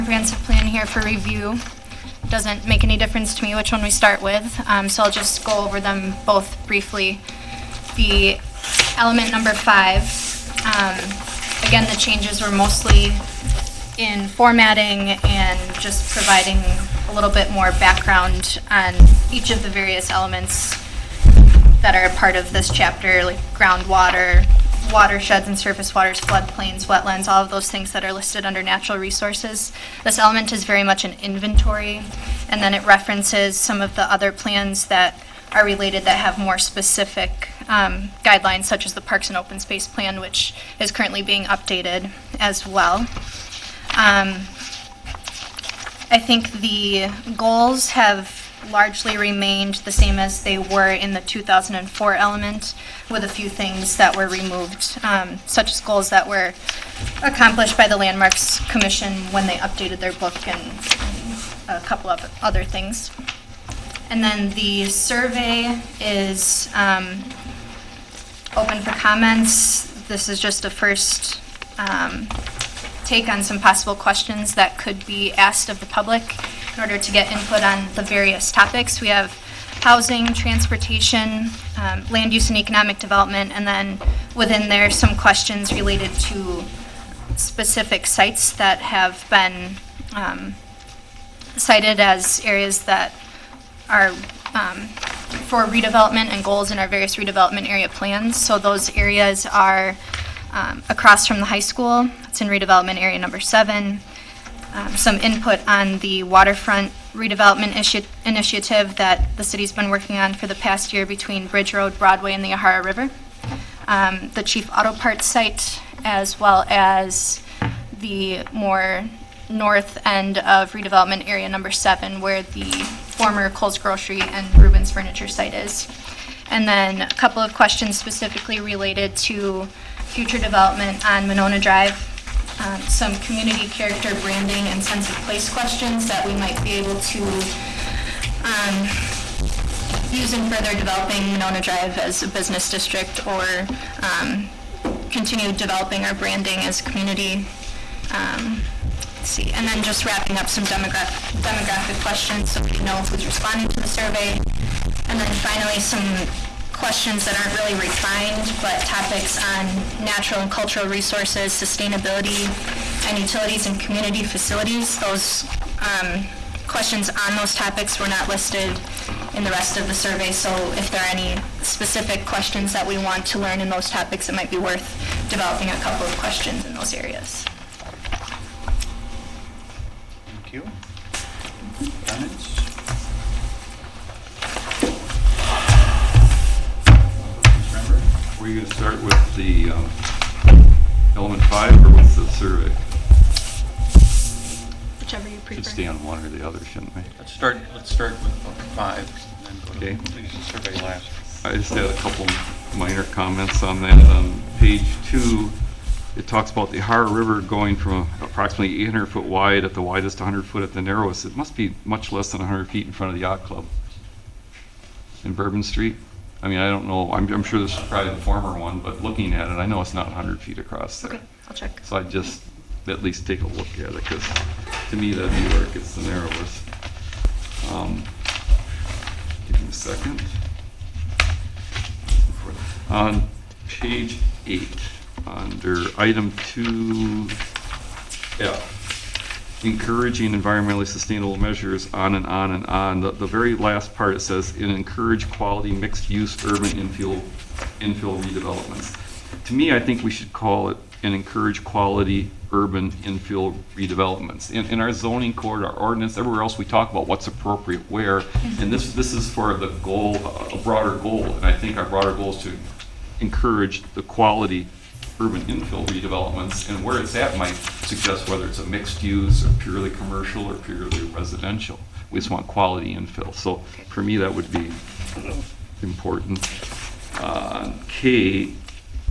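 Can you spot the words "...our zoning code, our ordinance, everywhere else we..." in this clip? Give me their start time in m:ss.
4:14.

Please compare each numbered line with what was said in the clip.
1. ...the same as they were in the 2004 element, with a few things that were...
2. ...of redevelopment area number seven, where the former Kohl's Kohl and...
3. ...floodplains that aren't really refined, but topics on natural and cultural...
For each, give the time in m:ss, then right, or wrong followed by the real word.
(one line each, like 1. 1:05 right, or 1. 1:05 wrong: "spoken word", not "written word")
1. 0:49 right
2. 2:00 wrong: "Grocery", not "Kohl"
3. 2:36 wrong: "questions", not "floodplains".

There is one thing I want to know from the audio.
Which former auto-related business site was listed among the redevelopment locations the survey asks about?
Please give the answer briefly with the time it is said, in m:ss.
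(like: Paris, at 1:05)
Chief Auto Parts, at 1:54.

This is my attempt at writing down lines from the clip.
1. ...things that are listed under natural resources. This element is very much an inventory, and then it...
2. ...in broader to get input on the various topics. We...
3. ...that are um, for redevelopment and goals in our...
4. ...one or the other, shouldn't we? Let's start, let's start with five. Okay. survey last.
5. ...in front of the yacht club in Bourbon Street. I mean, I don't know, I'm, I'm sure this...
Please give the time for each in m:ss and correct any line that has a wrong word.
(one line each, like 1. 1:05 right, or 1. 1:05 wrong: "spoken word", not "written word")
1. 0:27 right
2. 1:16 wrong: "order", not "broader"
3. 1:32 right
4. 3:16 right
5. 3:32 right.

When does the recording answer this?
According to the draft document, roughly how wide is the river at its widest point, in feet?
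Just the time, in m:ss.
3:28.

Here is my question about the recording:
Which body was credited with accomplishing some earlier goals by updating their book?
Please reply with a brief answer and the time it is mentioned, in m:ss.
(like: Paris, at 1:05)
Landmarks Commission, at 0:57.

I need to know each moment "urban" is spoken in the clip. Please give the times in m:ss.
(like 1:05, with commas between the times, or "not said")
4:06, 4:12, 4:25.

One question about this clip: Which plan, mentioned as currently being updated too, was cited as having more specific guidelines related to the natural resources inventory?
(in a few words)
Parks and Open Space Plan.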